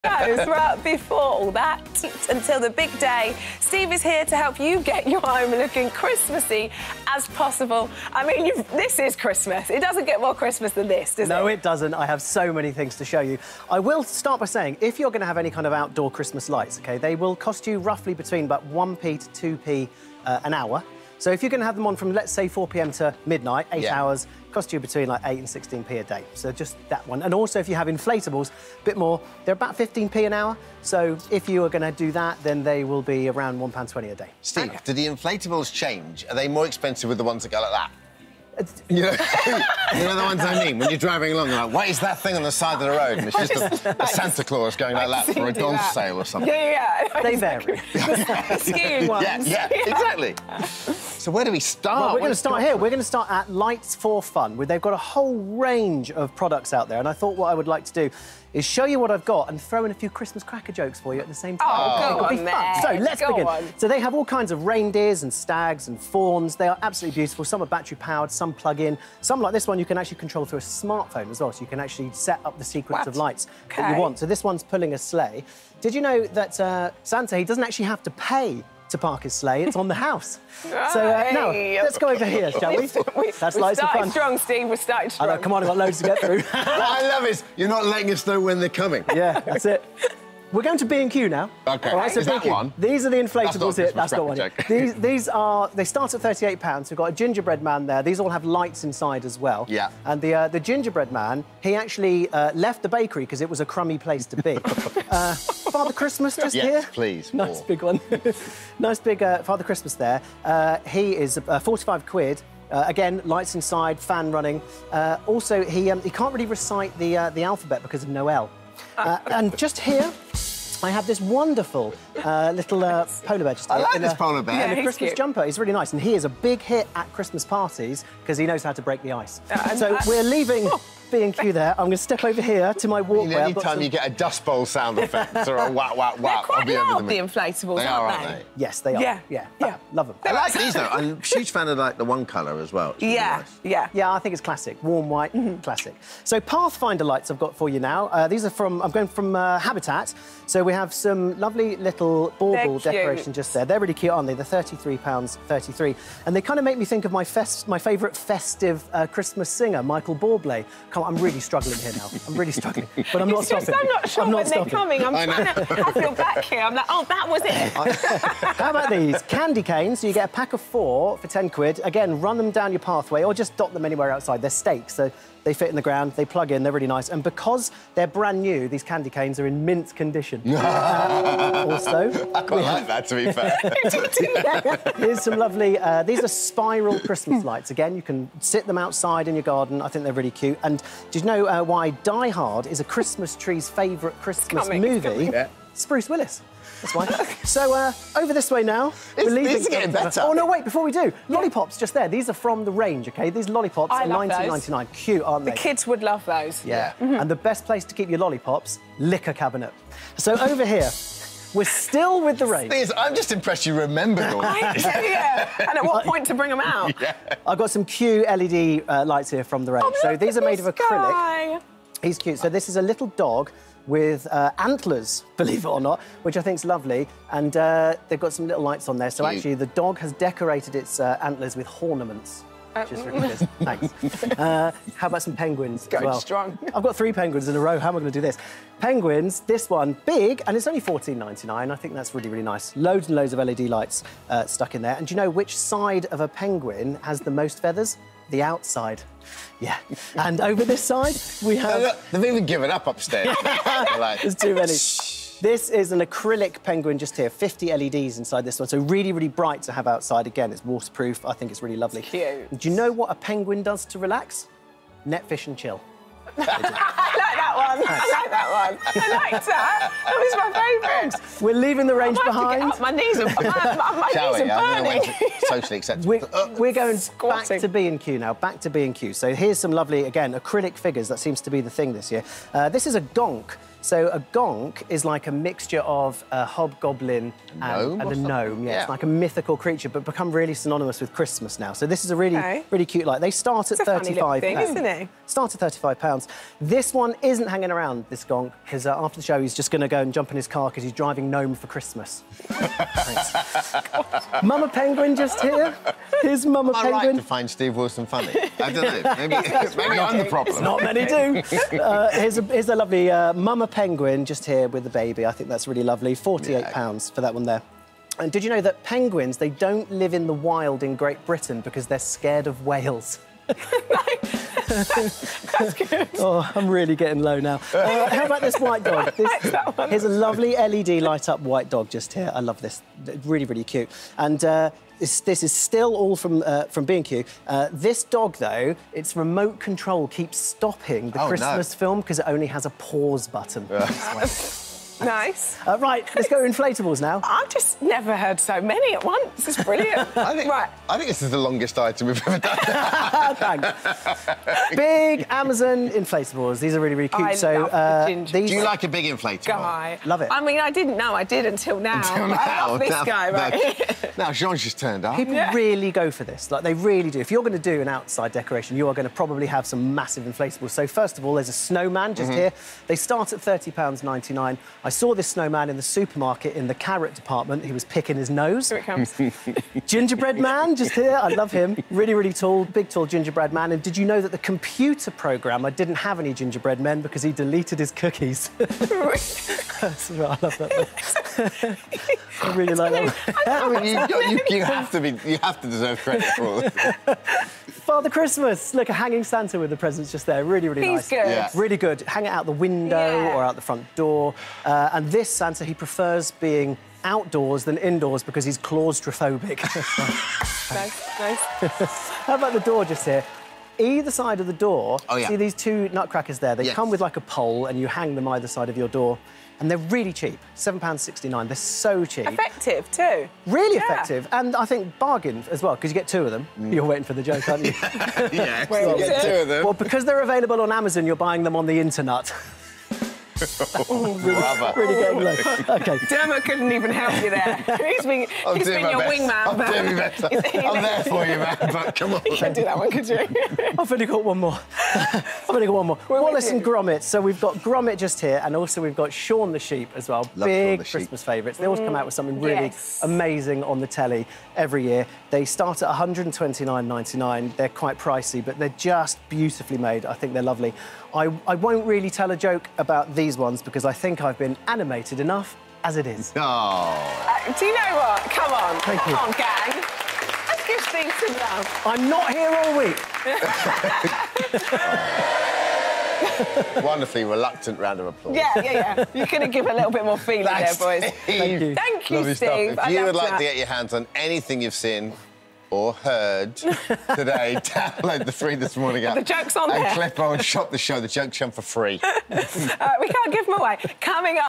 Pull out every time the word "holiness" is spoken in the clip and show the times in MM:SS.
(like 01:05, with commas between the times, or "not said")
not said.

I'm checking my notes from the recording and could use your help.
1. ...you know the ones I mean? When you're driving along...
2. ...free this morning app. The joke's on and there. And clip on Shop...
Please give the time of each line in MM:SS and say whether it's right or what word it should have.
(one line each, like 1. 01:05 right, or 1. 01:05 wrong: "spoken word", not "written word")
1. 00:39 right
2. 08:08 right.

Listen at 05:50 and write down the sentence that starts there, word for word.
I think this is the longest item we've ever done.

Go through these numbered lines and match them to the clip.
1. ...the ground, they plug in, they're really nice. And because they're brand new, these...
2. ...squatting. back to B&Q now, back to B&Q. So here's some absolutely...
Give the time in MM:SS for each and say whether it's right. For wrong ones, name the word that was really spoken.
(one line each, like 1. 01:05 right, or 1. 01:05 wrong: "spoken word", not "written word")
1. 02:55 right
2. 04:36 wrong: "lovely", not "absolutely".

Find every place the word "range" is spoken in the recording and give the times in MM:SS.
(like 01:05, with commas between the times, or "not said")
00:55, 03:22, 03:32, 03:39, 04:31.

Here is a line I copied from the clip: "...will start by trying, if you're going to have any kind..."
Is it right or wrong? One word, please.
wrong.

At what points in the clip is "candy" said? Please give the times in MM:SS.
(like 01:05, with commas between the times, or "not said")
02:49, 02:58.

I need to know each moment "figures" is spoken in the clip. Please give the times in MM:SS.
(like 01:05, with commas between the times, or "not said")
04:40.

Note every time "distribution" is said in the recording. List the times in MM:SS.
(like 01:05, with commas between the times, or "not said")
not said.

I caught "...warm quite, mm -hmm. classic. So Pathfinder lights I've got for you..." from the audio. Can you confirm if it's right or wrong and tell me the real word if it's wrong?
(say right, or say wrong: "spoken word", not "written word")
wrong: "white", not "quite".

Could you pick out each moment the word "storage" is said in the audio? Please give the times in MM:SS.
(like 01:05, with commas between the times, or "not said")
not said.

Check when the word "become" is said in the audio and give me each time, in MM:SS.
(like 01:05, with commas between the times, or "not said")
04:50.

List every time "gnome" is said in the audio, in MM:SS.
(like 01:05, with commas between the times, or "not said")
04:48, 05:01.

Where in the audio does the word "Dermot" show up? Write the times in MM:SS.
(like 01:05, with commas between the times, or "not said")
07:16.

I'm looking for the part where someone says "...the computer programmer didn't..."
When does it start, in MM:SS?
06:24.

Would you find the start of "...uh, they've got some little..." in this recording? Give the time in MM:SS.
03:47.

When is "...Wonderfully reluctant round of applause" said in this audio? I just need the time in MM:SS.
07:56.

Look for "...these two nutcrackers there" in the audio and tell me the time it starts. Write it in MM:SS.
06:55.